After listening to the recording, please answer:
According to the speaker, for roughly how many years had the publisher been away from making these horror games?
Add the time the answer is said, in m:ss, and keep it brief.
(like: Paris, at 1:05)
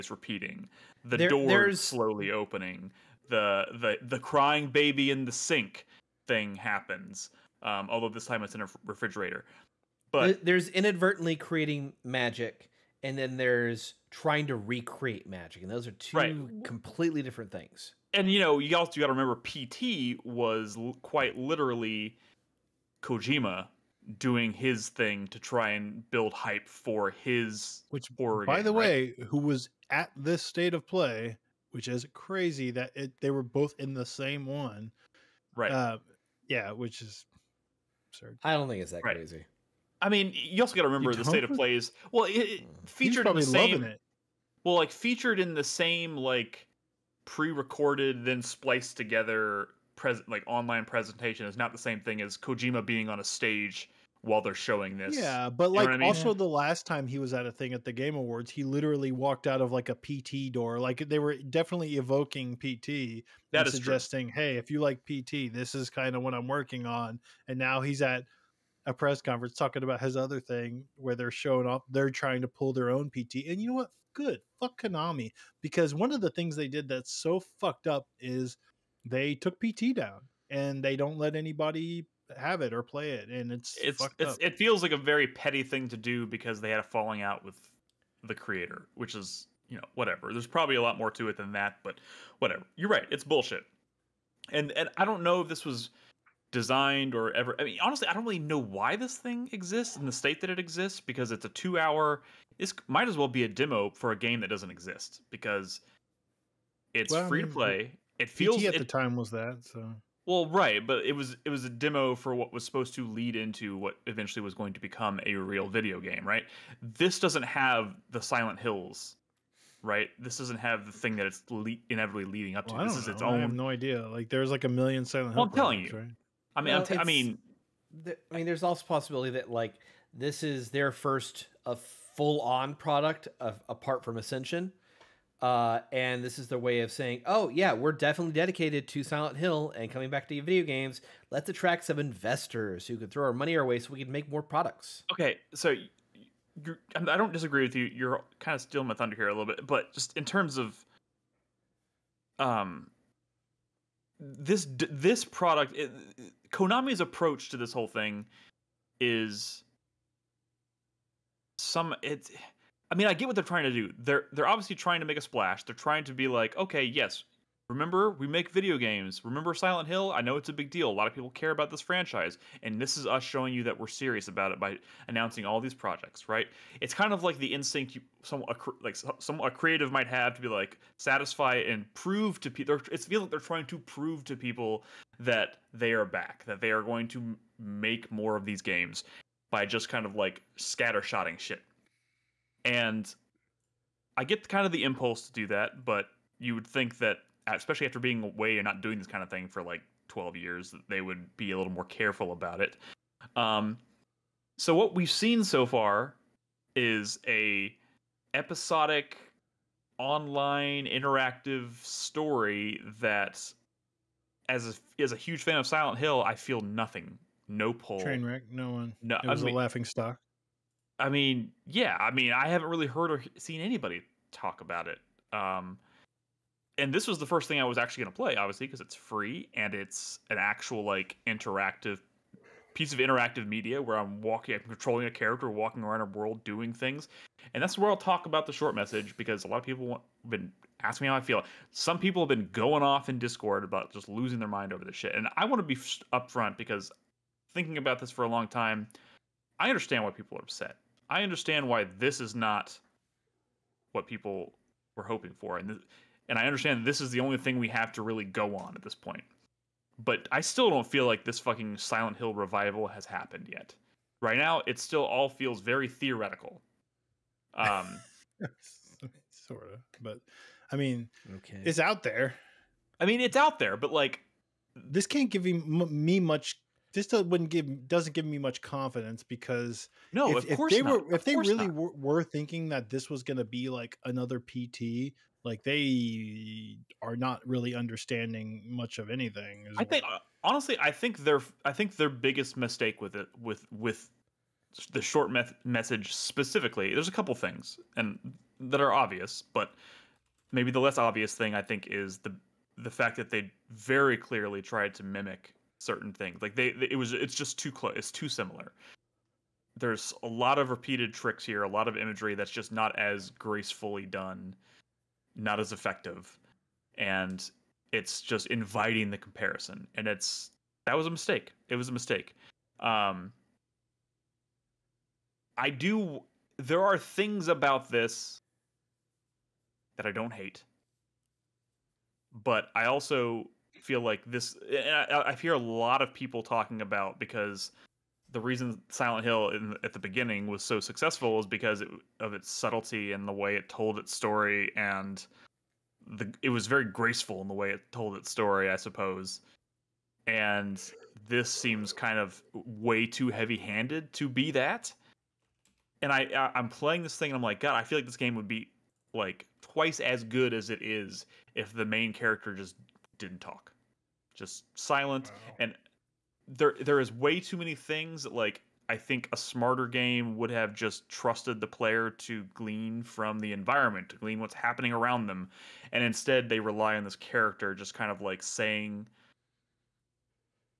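12, at 3:20.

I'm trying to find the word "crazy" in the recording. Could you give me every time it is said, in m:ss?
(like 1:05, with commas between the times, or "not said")
0:32, 0:39.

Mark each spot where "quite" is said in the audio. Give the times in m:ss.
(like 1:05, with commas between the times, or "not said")
0:21.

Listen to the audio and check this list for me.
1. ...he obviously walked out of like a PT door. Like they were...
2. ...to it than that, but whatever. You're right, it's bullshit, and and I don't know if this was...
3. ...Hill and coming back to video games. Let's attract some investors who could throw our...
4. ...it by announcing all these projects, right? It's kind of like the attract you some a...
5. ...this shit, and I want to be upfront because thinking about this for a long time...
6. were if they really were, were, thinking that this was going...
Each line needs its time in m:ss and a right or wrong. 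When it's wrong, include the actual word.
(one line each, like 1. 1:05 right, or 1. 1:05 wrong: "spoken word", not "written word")
1. 0:58 wrong: "literally", not "obviously"
2. 1:31 right
3. 2:19 right
4. 2:54 wrong: "instinct", not "attract"
5. 4:04 right
6. 4:41 right.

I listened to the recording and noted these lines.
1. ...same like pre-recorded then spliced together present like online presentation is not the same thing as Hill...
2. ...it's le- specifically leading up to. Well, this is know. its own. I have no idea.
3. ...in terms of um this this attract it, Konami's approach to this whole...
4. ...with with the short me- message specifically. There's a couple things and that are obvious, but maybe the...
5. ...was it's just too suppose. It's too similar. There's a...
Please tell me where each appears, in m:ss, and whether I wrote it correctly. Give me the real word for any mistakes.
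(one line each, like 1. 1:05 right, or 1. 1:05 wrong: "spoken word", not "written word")
1. 0:45 wrong: "Kojima", not "Hill"
2. 2:01 wrong: "inevitably", not "specifically"
3. 2:30 wrong: "product", not "attract"
4. 4:53 right
5. 5:06 wrong: "close", not "suppose".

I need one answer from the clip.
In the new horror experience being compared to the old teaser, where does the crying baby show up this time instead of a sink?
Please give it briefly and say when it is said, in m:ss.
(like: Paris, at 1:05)
refrigerator, at 0:08.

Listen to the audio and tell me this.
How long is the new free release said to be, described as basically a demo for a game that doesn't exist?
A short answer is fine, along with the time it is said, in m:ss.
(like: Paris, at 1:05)
2 hours, at 1:41.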